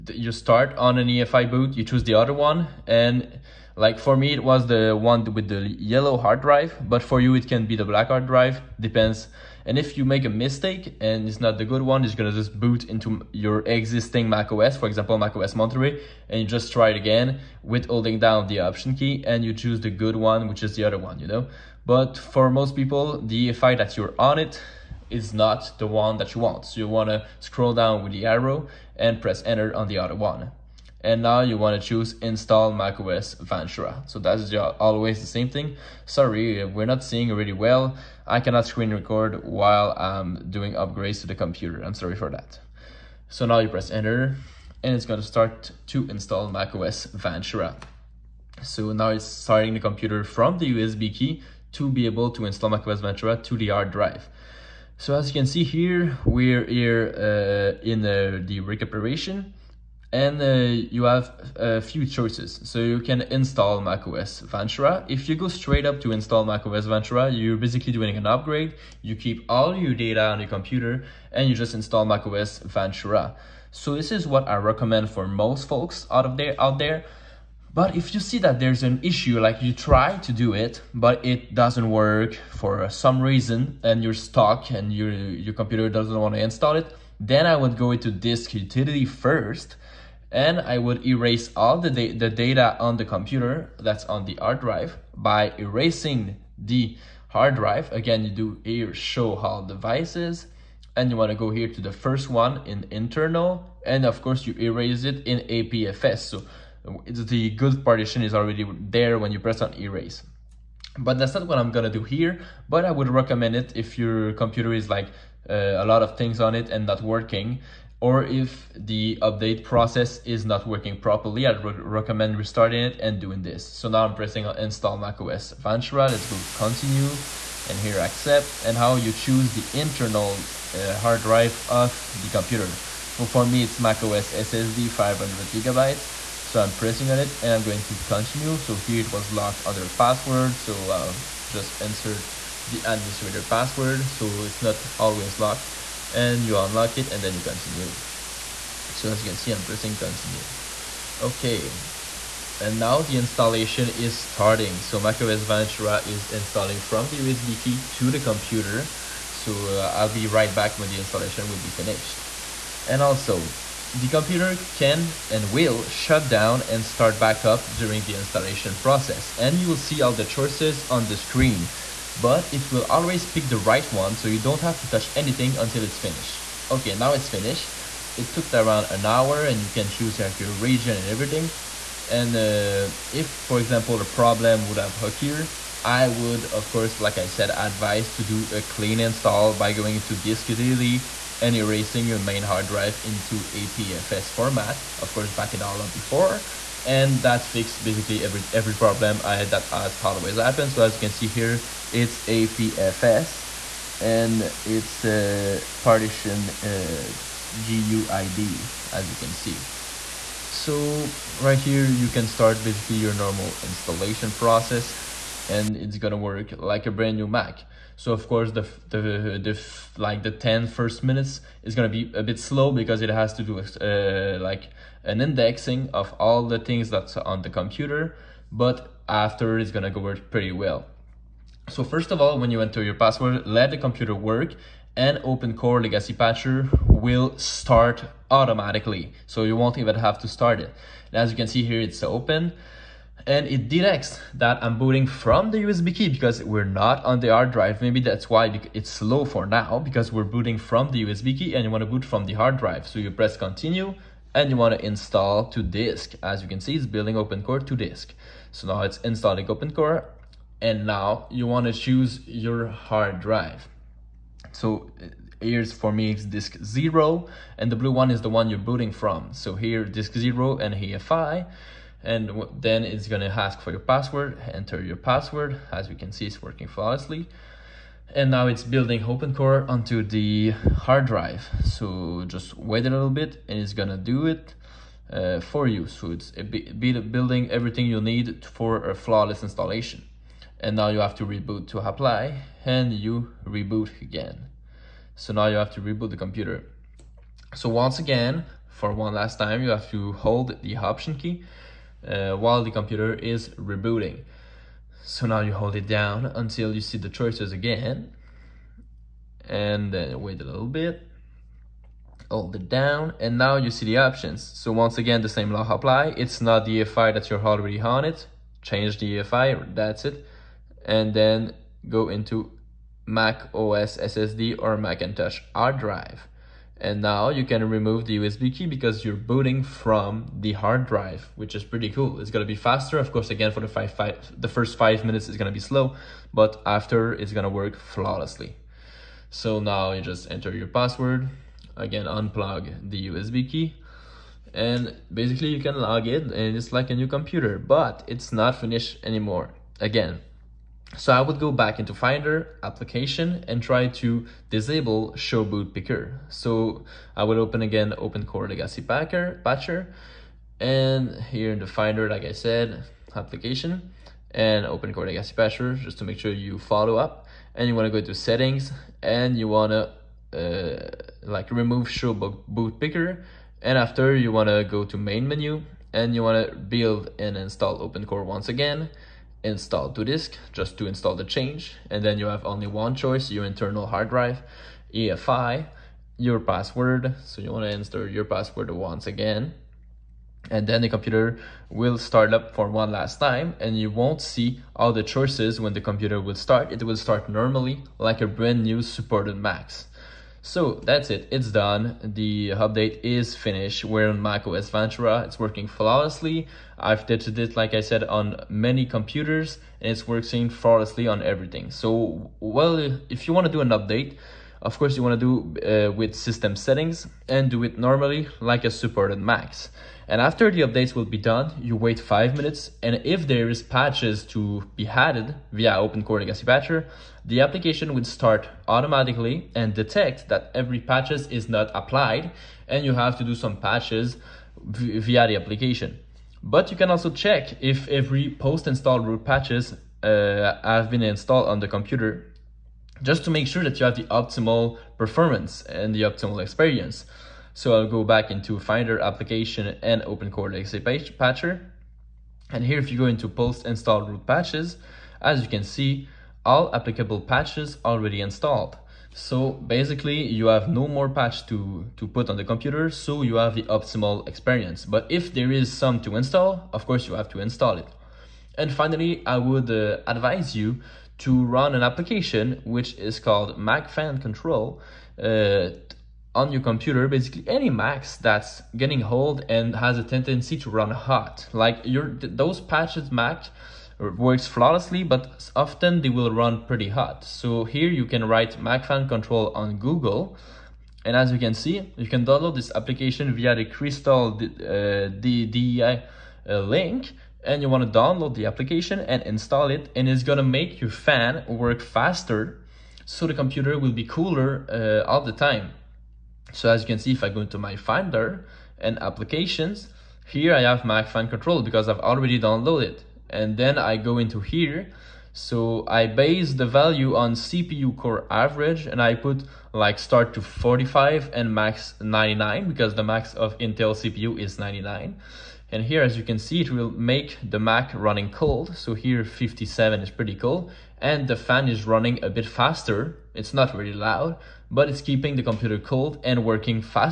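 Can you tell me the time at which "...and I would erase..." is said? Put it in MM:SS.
01:30.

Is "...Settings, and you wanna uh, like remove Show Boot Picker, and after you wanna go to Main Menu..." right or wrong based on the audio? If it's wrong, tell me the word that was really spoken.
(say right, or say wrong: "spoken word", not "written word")
right.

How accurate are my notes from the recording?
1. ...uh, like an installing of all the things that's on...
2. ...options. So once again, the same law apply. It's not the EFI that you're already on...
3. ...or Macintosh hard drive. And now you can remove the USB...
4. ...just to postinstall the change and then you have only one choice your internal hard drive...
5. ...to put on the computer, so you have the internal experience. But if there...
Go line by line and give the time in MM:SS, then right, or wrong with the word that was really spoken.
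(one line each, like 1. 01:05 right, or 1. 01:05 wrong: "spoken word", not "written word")
1. 03:43 wrong: "indexing", not "installing"
2. 05:13 right
3. 05:24 right
4. 06:20 wrong: "install", not "postinstall"
5. 07:41 wrong: "optimal", not "internal".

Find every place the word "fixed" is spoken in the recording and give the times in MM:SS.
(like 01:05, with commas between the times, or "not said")
03:17.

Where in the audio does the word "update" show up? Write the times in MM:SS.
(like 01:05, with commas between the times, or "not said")
01:59, 06:42, 06:53, 07:00.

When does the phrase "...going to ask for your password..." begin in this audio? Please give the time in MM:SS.
04:33.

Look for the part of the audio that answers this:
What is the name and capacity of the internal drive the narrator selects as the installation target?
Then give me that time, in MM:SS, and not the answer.
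02:13.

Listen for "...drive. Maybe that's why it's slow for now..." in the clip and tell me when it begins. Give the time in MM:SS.
04:07.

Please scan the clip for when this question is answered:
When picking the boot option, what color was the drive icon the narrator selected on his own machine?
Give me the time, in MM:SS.
00:05.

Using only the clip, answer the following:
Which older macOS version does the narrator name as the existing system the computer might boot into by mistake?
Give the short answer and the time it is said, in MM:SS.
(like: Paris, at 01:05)
Monterey, at 00:15.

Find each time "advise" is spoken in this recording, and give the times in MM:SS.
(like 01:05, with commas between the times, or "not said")
03:07, 07:50.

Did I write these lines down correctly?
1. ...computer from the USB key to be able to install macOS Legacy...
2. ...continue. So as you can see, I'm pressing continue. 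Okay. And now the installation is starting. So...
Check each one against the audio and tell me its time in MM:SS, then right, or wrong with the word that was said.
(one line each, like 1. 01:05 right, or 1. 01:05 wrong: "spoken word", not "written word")
1. 00:49 wrong: "Ventura", not "Legacy"
2. 02:27 right.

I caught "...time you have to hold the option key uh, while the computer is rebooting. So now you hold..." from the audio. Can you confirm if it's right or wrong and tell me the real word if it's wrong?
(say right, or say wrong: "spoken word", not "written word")
right.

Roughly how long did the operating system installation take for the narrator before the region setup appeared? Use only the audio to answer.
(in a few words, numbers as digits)
around an hour.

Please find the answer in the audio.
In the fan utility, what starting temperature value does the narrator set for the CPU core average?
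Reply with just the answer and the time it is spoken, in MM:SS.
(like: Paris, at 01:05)
45, at 08:40.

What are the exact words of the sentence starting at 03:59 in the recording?
So you won't even have to start it.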